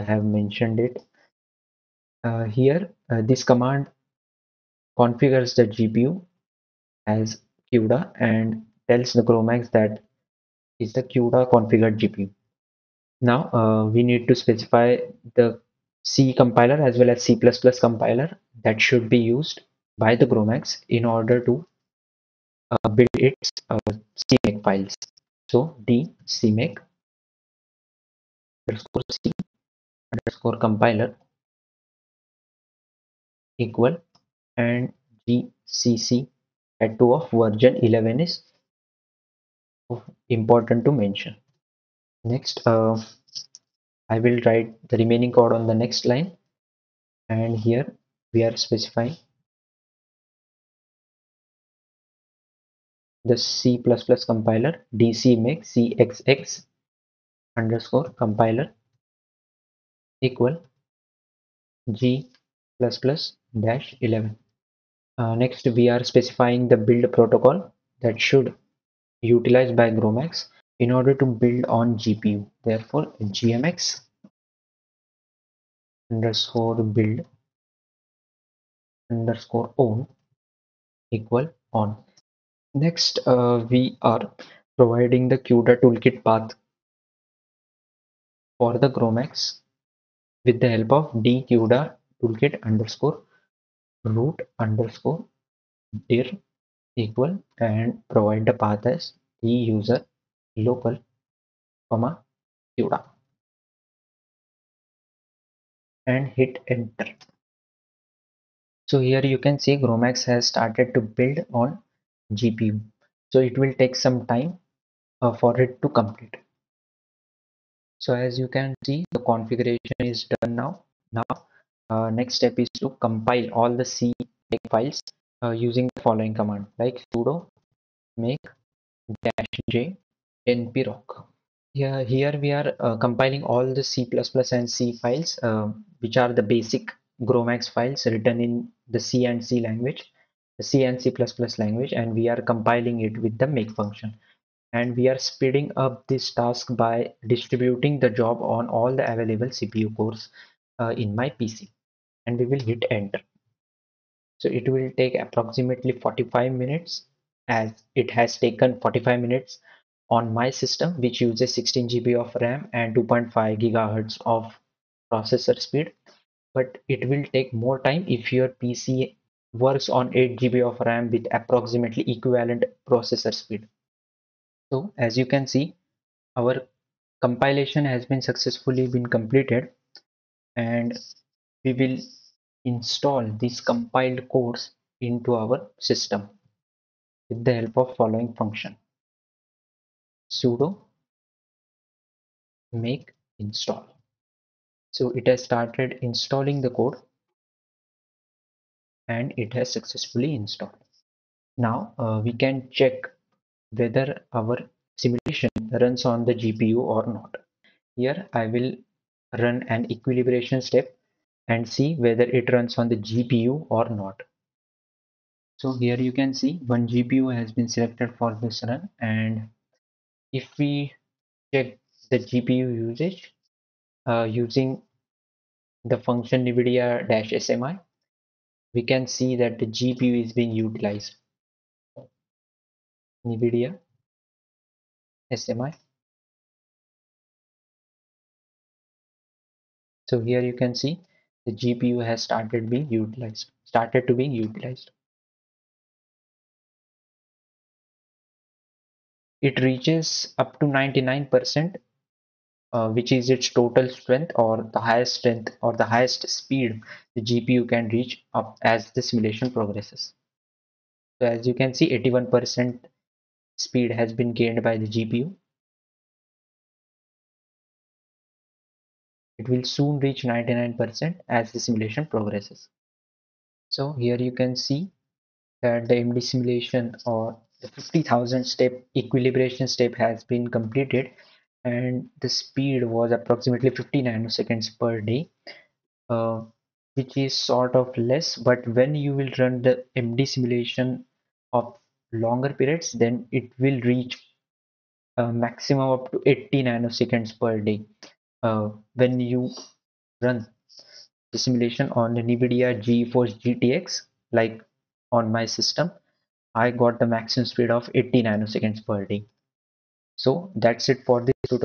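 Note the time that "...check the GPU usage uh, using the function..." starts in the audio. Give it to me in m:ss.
3:41.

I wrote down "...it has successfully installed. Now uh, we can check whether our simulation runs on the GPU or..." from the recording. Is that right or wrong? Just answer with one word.
right.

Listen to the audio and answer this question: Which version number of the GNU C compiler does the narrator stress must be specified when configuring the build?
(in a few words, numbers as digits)
11.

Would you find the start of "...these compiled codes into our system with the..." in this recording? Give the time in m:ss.
3:03.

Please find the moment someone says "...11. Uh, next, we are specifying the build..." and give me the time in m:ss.
1:04.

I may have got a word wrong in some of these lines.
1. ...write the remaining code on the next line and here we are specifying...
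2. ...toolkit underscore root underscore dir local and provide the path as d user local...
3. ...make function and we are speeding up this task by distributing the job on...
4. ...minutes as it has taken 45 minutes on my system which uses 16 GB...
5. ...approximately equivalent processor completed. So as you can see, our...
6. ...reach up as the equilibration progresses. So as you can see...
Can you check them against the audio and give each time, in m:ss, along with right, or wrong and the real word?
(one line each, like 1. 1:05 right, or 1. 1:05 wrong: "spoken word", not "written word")
1. 0:44 right
2. 1:32 wrong: "equal", not "local"
3. 2:23 right
4. 2:36 right
5. 2:51 wrong: "speed", not "completed"
6. 4:17 wrong: "simulation", not "equilibration".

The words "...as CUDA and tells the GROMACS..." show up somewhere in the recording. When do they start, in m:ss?
0:07.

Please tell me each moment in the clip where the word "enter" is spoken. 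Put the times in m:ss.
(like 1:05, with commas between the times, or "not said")
1:46, 2:32.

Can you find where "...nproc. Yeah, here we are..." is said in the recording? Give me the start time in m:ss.
2:10.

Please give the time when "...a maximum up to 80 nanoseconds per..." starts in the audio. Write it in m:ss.
4:55.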